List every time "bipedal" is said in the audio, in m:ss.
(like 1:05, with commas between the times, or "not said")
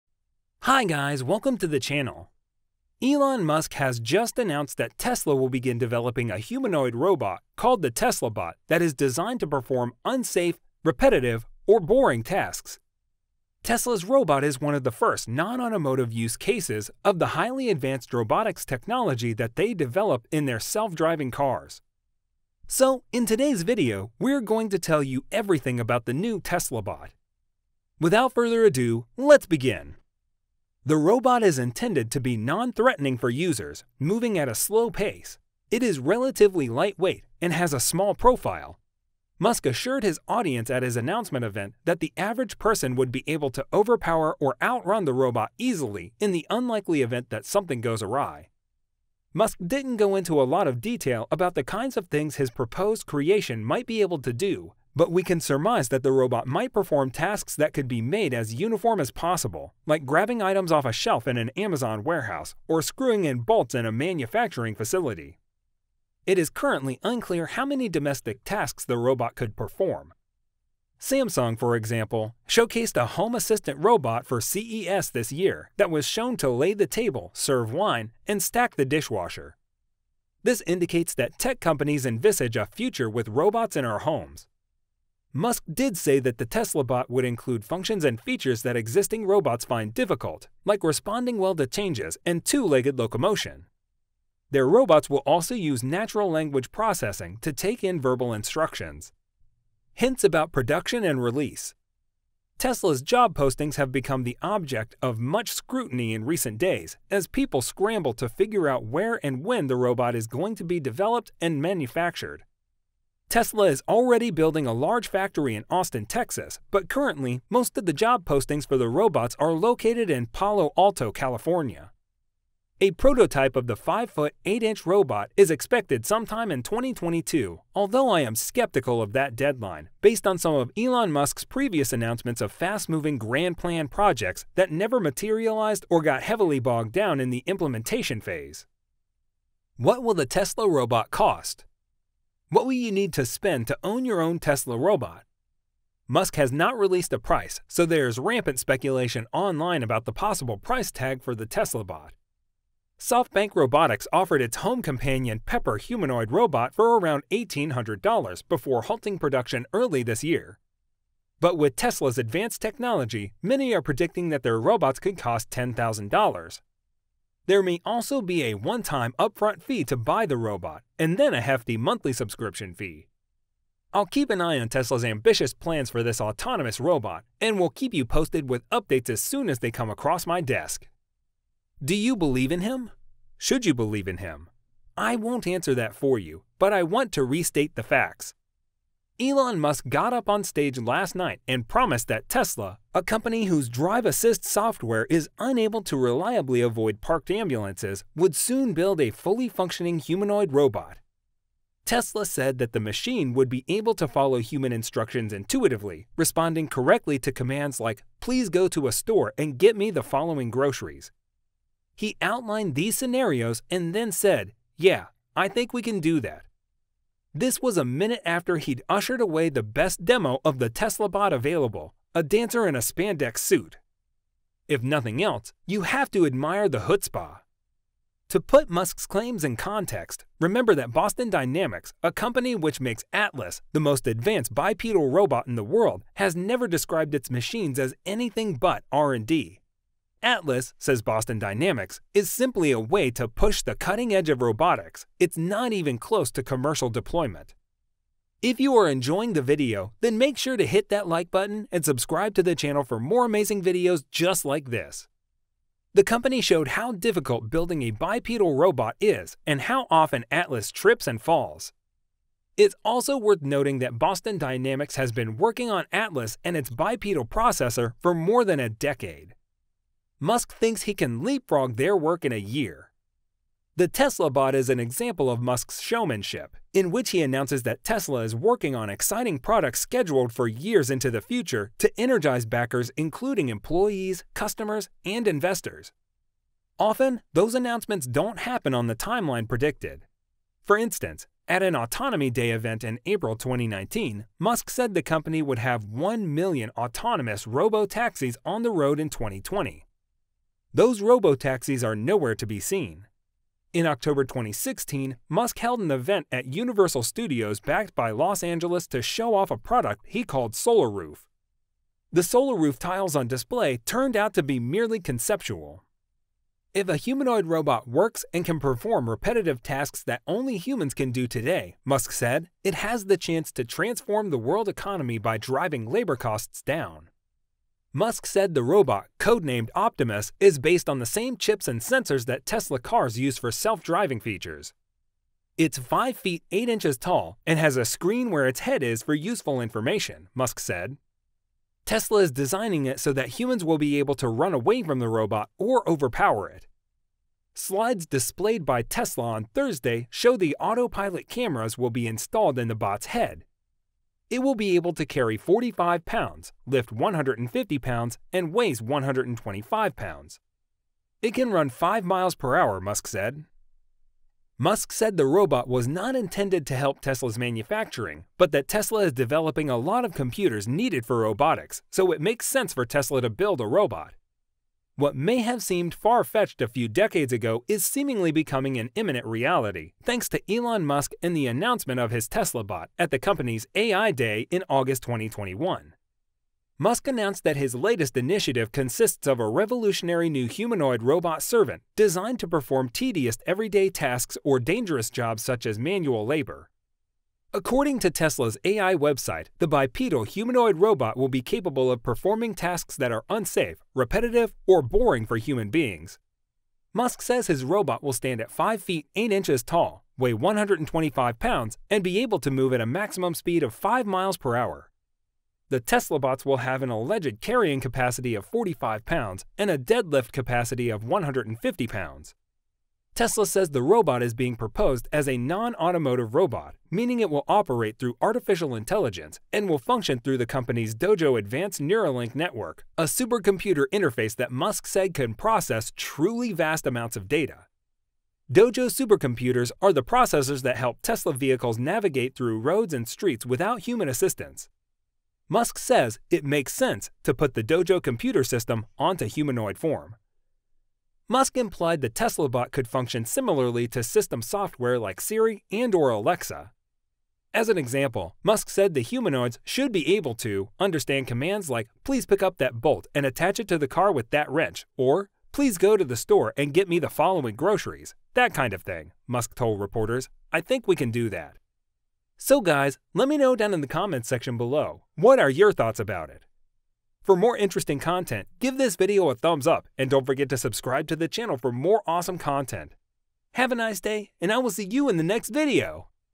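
3:54, 4:17, 4:26, 6:39.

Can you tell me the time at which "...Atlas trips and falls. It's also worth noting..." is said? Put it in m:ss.
4:20.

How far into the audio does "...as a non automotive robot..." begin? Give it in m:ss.
7:05.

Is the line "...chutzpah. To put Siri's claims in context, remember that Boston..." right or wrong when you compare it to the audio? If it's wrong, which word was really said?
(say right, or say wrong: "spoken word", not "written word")
wrong: "Musk", not "Siri".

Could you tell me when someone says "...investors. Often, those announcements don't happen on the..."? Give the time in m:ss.
4:45.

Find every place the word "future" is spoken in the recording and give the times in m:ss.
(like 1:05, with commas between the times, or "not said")
1:22, 4:41.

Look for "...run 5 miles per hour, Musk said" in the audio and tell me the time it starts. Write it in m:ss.
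6:01.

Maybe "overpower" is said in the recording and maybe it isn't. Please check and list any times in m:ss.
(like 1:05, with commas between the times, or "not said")
0:43, 5:45.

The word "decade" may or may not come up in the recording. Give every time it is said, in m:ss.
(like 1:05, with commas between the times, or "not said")
4:28, 6:16.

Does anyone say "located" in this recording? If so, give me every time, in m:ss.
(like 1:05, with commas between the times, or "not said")
1:59.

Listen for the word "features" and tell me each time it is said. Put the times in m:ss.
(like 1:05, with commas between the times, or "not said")
1:28, 5:34.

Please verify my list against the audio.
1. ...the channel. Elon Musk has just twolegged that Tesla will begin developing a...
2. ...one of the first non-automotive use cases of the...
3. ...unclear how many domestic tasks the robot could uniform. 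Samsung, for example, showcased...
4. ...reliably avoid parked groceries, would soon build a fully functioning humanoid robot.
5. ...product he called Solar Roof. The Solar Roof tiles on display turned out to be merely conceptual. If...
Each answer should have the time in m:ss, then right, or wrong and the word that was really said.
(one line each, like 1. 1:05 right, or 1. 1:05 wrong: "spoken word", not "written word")
1. 0:01 wrong: "announced", not "twolegged"
2. 0:14 right
3. 1:07 wrong: "perform", not "uniform"
4. 3:15 wrong: "ambulances", not "groceries"
5. 5:09 right.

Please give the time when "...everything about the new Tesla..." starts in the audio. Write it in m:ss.
0:25.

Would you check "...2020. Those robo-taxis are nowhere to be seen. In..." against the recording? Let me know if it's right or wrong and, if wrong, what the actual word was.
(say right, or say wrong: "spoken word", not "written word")
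right.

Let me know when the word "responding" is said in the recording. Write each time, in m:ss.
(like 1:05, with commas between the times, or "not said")
1:30, 3:26.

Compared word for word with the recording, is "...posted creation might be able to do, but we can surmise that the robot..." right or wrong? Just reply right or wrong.
wrong.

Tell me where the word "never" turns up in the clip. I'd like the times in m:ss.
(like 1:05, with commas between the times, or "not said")
2:14, 3:56.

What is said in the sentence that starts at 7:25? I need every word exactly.
Musk says it makes sense to put the Dojo computer system onto humanoid form.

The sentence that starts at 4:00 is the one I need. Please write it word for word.
Atlas, says Boston Dynamics, is simply a way to push the cutting edge of robotics.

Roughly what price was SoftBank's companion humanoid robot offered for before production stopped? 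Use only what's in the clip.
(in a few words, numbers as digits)
$1,800.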